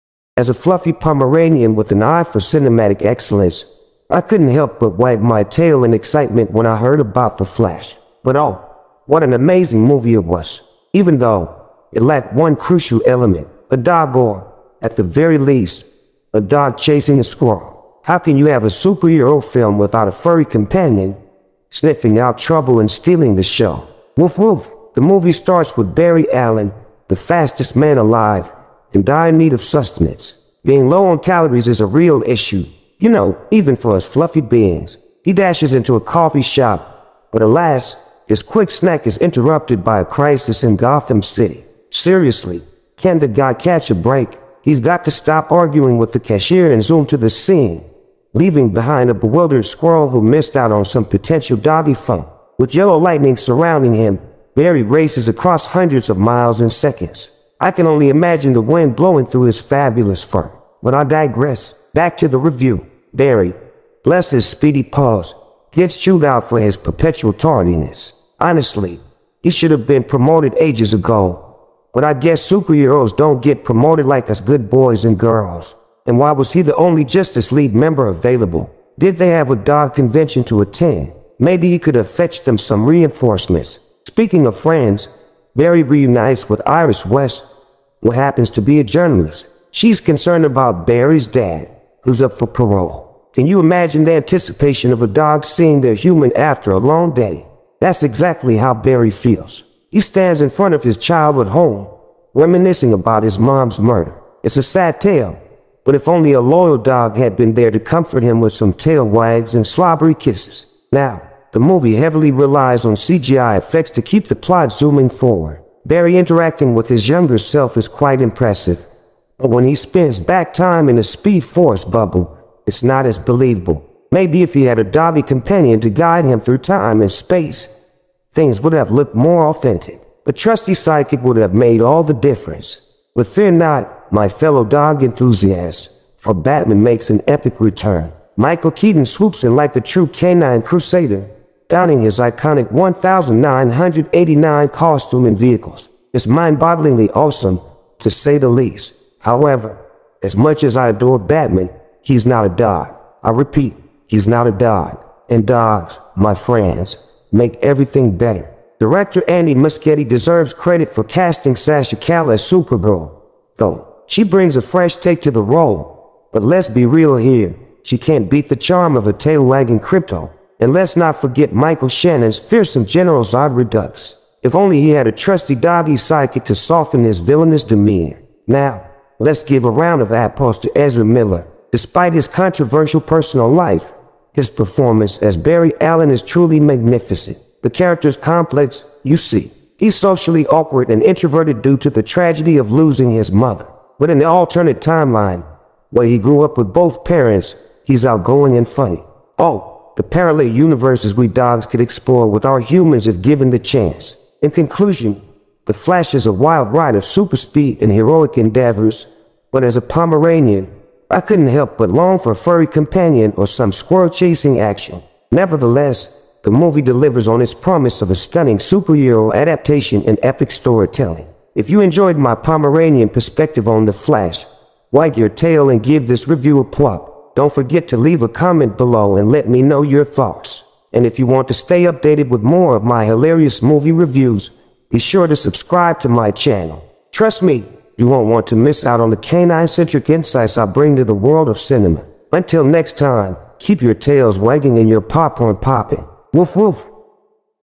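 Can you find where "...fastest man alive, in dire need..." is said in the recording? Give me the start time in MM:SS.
00:27.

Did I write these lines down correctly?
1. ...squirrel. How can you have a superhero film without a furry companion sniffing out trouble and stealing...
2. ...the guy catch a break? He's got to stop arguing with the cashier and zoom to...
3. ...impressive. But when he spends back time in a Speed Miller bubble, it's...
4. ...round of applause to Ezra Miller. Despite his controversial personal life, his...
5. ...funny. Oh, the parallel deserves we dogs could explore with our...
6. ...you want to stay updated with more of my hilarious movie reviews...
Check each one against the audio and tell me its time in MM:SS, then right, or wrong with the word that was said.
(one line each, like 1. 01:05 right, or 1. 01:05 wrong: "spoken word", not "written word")
1. 00:17 right
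2. 00:43 right
3. 01:58 wrong: "Force", not "Miller"
4. 02:59 right
5. 03:18 wrong: "universes", not "deserves"
6. 03:51 right.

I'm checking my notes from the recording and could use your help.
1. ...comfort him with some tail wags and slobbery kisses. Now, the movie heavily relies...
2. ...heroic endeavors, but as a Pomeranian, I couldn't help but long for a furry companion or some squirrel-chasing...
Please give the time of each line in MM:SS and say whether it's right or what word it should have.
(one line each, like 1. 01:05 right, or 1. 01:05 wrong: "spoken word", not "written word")
1. 01:47 right
2. 03:27 right.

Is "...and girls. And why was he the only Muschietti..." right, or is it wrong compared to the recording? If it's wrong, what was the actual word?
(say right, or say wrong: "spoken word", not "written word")
wrong: "Justice", not "Muschietti".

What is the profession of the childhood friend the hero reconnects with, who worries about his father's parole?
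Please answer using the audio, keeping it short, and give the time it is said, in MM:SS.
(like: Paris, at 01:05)
Journalist, at 01:28.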